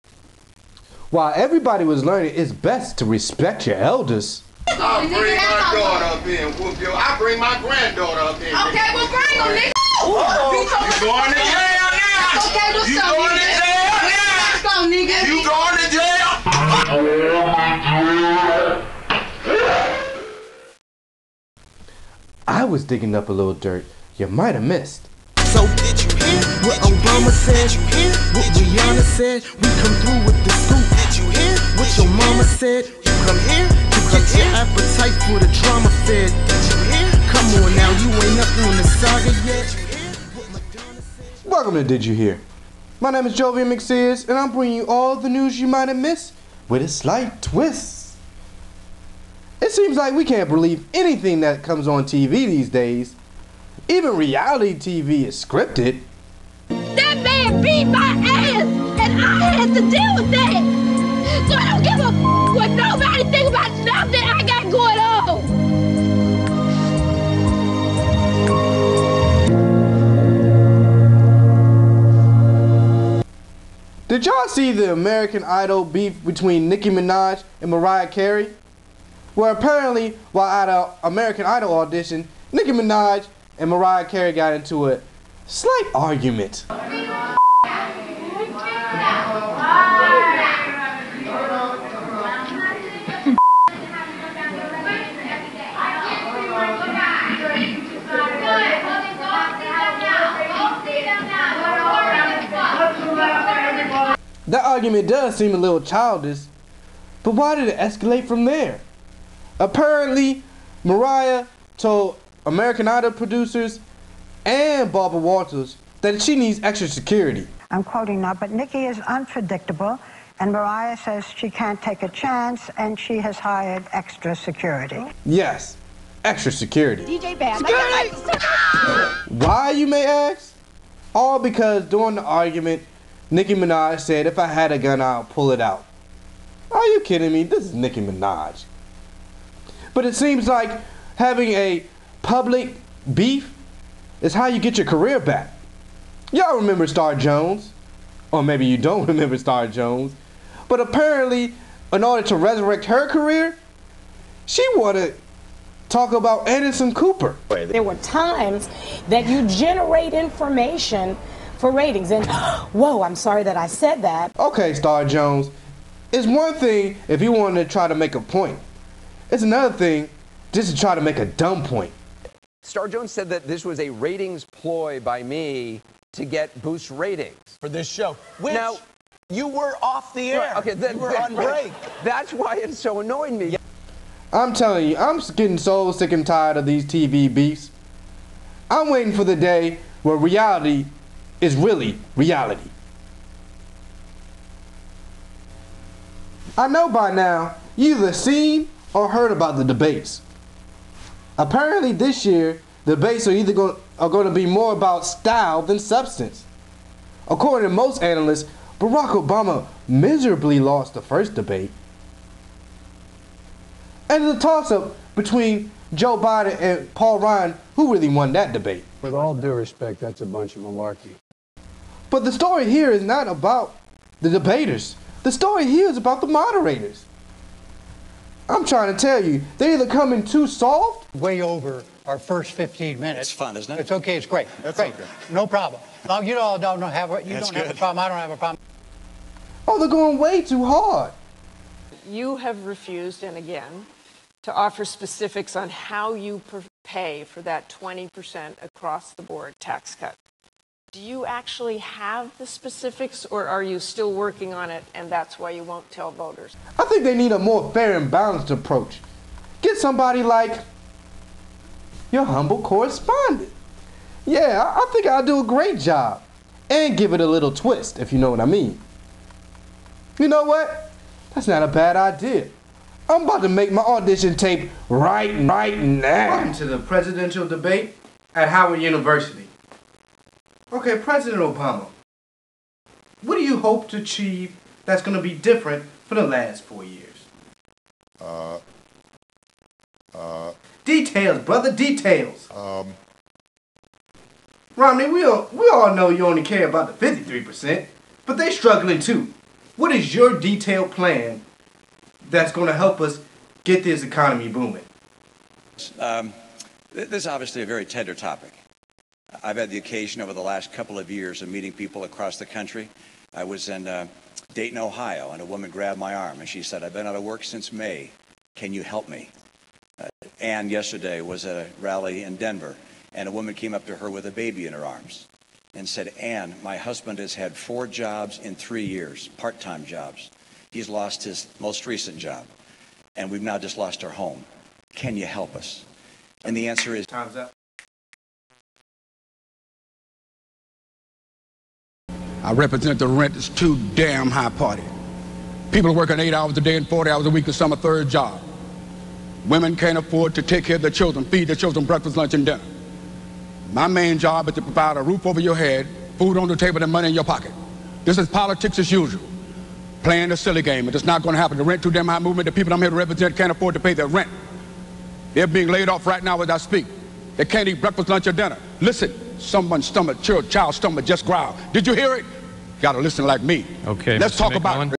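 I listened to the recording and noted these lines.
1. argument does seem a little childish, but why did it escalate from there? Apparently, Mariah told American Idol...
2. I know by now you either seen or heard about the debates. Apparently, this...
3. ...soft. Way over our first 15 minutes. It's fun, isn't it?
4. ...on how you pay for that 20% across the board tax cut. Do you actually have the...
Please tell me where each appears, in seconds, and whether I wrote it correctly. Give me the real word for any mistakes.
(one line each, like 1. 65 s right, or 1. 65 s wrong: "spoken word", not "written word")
1. 104 s right
2. 196 s right
3. 230 s right
4. 245 s right.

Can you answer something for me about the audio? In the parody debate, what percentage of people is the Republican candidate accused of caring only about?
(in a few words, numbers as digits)
53%.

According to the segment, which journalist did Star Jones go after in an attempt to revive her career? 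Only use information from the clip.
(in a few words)
Anderson Cooper.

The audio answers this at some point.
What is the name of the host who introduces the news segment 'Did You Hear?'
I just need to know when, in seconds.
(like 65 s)
43 s.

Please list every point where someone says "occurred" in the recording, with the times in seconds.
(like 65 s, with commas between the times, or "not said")
not said.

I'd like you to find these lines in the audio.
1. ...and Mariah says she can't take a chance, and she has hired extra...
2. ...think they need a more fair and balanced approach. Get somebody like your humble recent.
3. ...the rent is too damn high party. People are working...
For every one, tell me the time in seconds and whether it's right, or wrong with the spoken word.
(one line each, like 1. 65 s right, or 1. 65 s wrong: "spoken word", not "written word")
1. 120 s right
2. 256 s wrong: "correspondent", not "recent"
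3. 342 s right.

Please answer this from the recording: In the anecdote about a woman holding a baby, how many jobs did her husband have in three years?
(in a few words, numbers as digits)
4.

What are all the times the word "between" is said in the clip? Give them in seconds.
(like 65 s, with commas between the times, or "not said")
76 s, 215 s.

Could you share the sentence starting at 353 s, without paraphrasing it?
My main job is to provide a roof over your head, food on the table, and money in your pocket.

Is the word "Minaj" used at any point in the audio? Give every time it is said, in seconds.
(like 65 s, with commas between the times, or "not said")
76 s, 82 s, 133 s, 138 s.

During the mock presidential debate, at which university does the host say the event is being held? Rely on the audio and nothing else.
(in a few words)
Howard University.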